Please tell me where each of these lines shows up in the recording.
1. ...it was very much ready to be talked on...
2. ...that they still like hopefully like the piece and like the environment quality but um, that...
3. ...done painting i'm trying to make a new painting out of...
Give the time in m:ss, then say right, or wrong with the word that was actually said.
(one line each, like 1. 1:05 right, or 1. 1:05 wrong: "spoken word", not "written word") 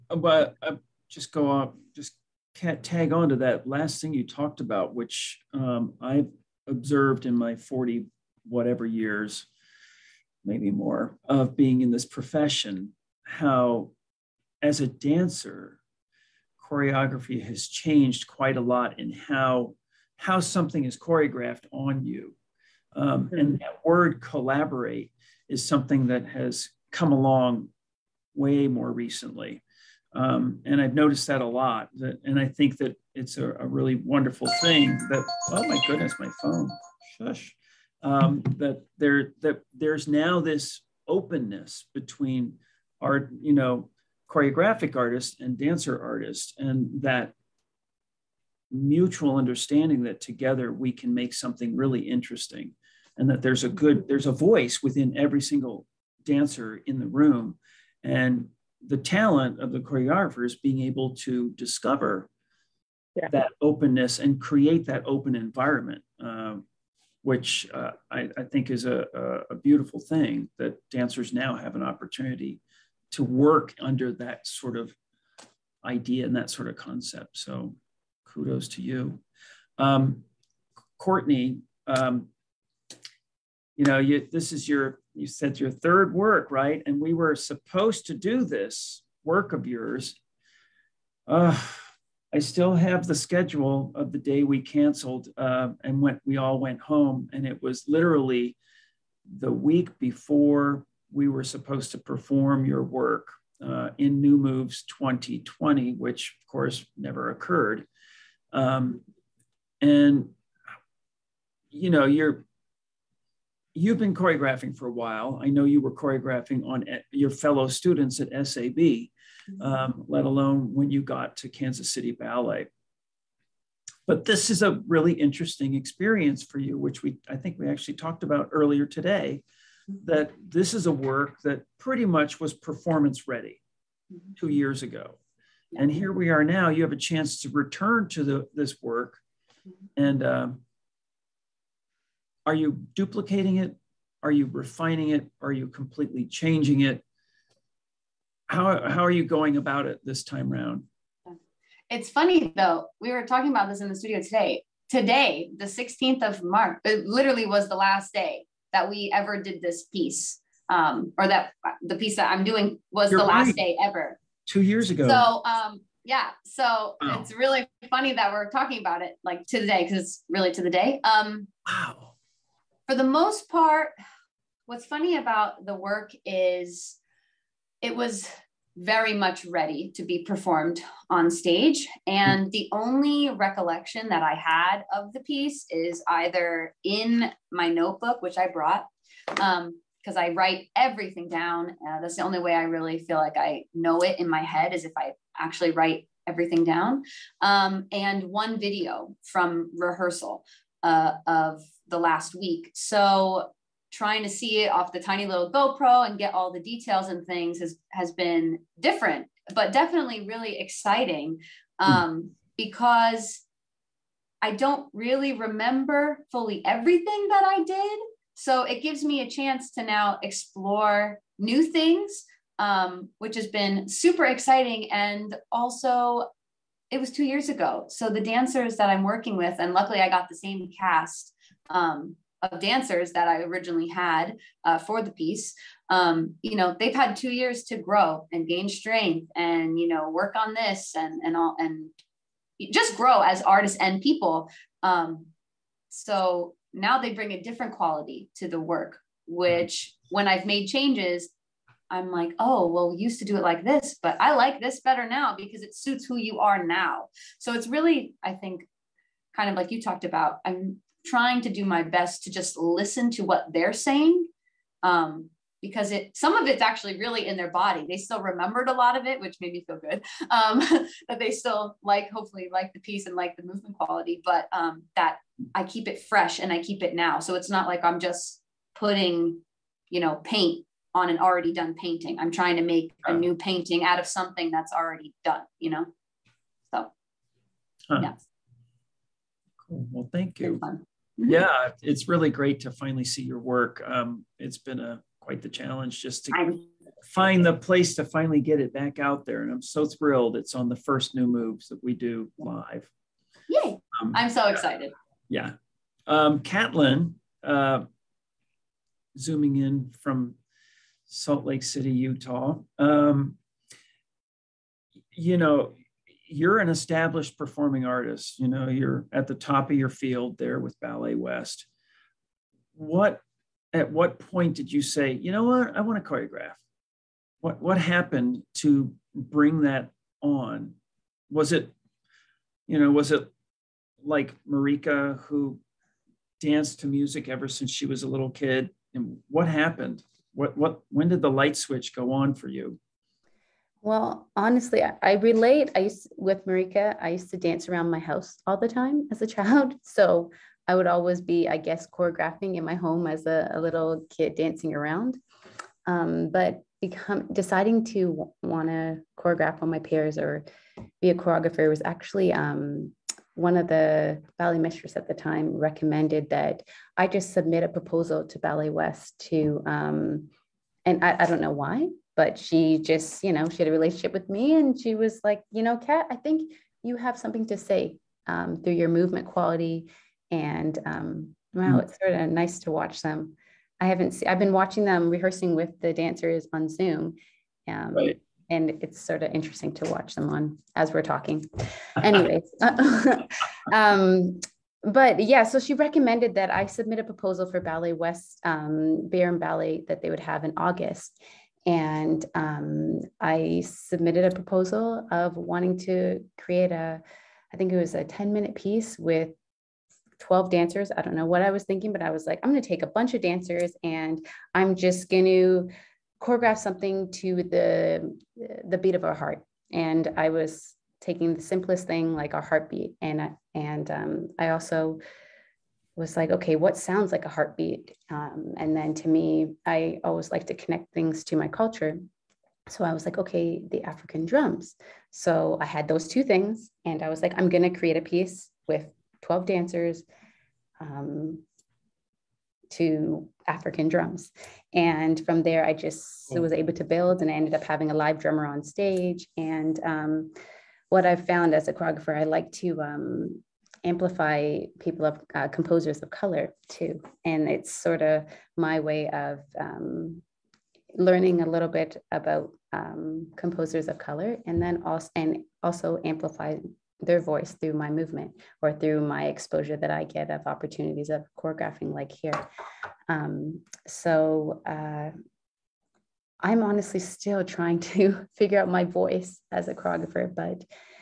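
1. 2:57 wrong: "performed", not "talked"
2. 4:31 wrong: "movement", not "environment"
3. 4:41 right.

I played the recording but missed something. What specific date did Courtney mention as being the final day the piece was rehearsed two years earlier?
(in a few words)
March 16.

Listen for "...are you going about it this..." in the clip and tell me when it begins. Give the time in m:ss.
2:29.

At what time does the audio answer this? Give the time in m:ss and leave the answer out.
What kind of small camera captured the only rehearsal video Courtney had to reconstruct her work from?
3:25.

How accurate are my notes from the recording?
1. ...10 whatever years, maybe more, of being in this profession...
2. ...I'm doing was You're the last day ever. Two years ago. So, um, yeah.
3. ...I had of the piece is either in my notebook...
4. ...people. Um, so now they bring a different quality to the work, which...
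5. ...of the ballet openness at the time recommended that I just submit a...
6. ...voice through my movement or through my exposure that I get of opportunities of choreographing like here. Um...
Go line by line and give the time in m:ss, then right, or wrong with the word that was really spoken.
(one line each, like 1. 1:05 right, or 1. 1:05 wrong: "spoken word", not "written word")
1. 0:07 wrong: "40", not "10"
2. 2:42 right
3. 3:04 right
4. 4:04 right
5. 6:03 wrong: "mistress", not "openness"
6. 7:47 right.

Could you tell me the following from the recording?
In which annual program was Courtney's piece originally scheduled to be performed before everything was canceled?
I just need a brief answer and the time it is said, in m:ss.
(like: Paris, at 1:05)
New Moves 2020, at 1:44.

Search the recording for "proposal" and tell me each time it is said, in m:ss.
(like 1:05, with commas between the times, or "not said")
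6:07, 6:37, 6:44.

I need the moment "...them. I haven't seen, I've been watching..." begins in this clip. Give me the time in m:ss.
6:23.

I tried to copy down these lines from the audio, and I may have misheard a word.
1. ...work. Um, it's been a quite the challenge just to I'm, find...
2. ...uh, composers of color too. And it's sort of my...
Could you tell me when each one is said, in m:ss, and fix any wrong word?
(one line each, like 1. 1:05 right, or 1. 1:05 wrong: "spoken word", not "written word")
1. 4:53 right
2. 7:35 right.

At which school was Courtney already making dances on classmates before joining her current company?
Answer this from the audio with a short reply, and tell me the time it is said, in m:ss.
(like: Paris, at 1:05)
SAB, at 1:58.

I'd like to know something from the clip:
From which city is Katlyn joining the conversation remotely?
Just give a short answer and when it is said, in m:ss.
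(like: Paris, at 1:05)
Salt Lake City, Utah, at 5:11.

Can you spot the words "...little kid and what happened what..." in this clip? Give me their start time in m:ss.
5:38.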